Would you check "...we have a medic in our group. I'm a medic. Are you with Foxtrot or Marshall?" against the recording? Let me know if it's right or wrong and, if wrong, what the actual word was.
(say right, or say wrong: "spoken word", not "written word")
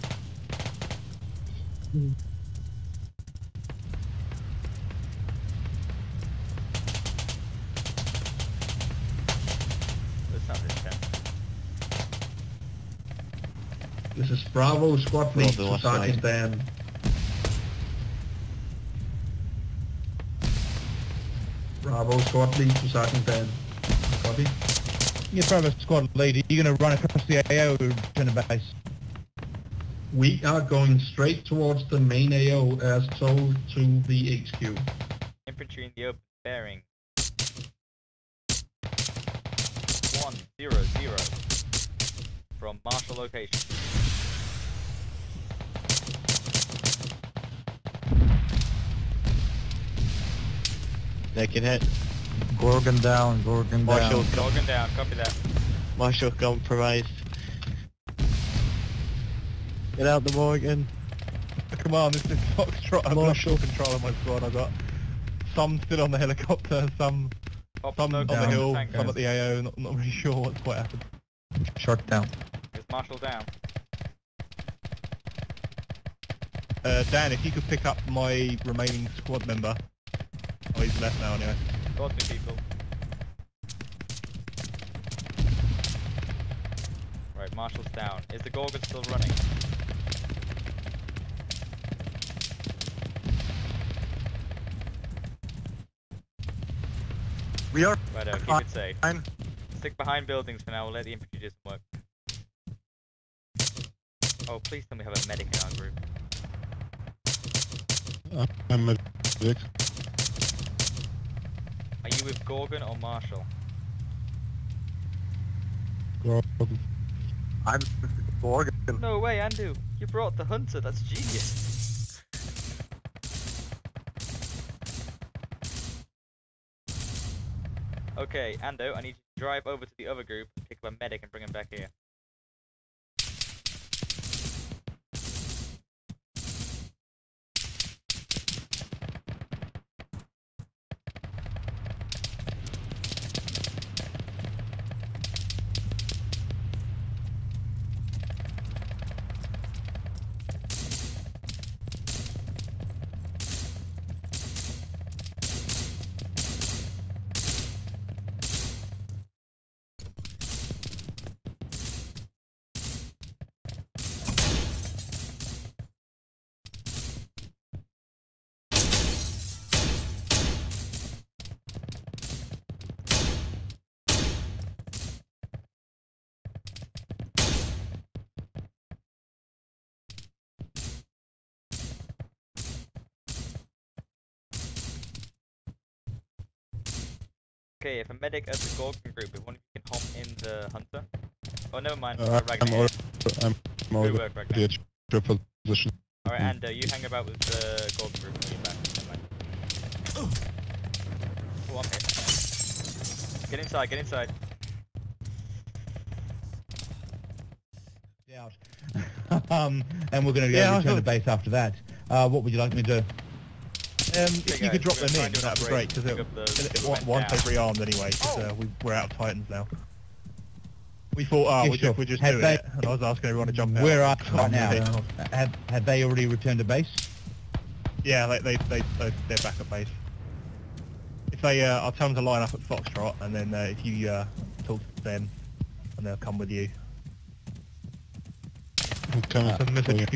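wrong: "Gorgon", not "Foxtrot".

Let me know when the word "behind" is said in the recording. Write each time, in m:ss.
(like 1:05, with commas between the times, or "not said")
1:39.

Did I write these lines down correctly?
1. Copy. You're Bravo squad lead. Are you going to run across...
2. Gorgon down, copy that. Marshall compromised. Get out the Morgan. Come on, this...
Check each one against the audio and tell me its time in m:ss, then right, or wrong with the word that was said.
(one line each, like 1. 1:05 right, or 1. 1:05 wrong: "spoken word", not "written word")
1. 0:24 right
2. 0:54 right.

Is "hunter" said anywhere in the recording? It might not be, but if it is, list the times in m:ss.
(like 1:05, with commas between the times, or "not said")
2:00, 3:10.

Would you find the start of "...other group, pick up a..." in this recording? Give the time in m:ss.
2:10.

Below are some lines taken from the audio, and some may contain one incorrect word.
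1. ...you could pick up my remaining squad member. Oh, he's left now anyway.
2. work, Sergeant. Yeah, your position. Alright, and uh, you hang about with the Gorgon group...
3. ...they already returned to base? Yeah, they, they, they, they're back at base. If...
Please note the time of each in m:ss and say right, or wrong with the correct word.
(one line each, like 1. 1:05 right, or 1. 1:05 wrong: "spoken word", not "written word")
1. 1:17 right
2. 3:14 wrong: "Ragnar", not "Sergeant"
3. 3:45 right.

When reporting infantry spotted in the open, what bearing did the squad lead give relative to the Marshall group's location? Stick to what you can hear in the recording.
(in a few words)
100.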